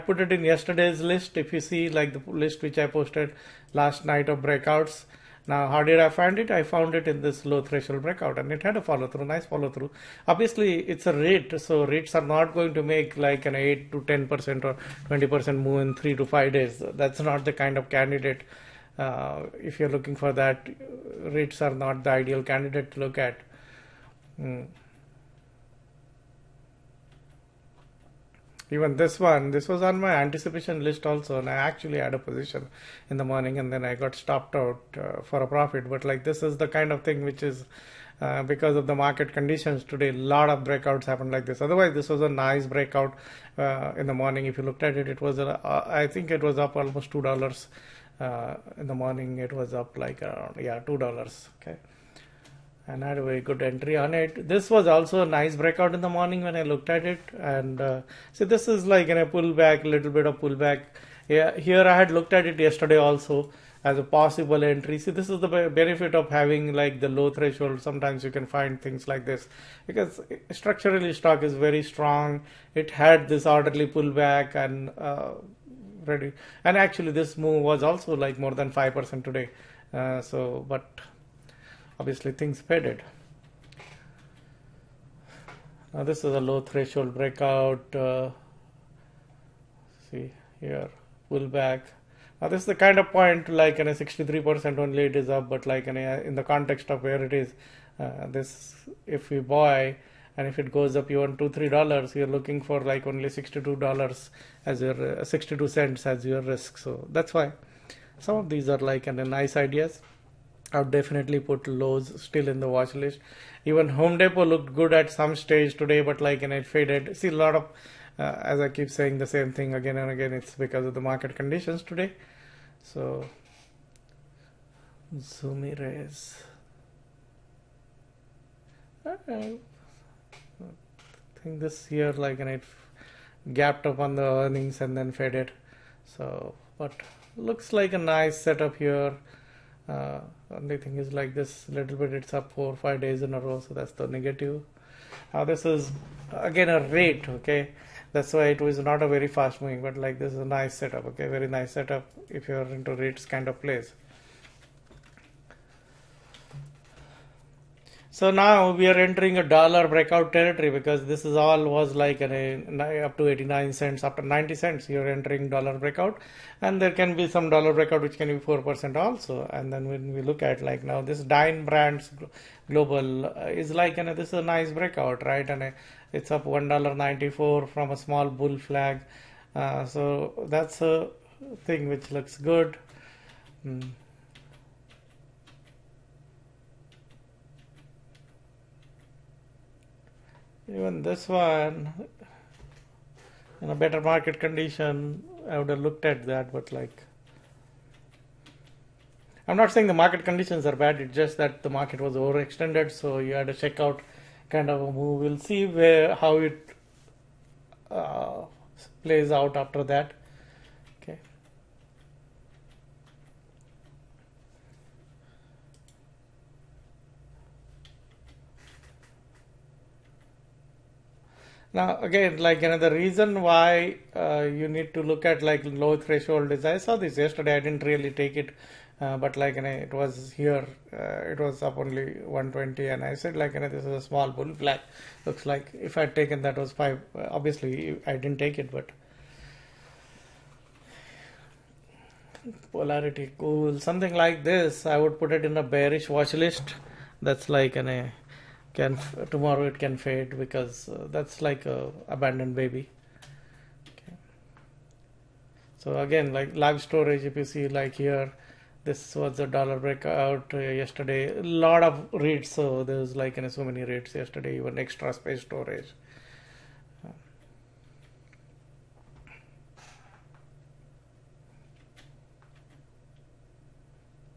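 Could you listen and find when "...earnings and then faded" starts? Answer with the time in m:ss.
2:14.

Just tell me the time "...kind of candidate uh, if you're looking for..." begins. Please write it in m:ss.
0:17.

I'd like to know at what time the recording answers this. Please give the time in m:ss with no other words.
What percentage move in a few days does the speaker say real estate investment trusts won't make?
0:13.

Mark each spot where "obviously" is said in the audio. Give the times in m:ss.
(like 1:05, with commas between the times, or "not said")
0:10, 1:21, 3:57.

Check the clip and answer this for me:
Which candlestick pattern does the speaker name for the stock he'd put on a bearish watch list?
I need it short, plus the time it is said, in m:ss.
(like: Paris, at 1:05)
abandoned baby, at 4:12.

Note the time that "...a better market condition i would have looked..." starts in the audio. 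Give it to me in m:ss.
3:13.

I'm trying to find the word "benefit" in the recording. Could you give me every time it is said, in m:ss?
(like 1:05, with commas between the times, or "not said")
1:05.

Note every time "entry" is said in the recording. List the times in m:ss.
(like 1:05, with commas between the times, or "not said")
0:53, 1:04.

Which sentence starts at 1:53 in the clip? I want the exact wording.
Even Home Depot looked good at some stage today, but like and it faded.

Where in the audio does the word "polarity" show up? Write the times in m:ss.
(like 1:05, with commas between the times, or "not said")
4:02.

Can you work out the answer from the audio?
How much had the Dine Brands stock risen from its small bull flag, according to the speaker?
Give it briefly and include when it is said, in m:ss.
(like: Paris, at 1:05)
$1.94, at 2:56.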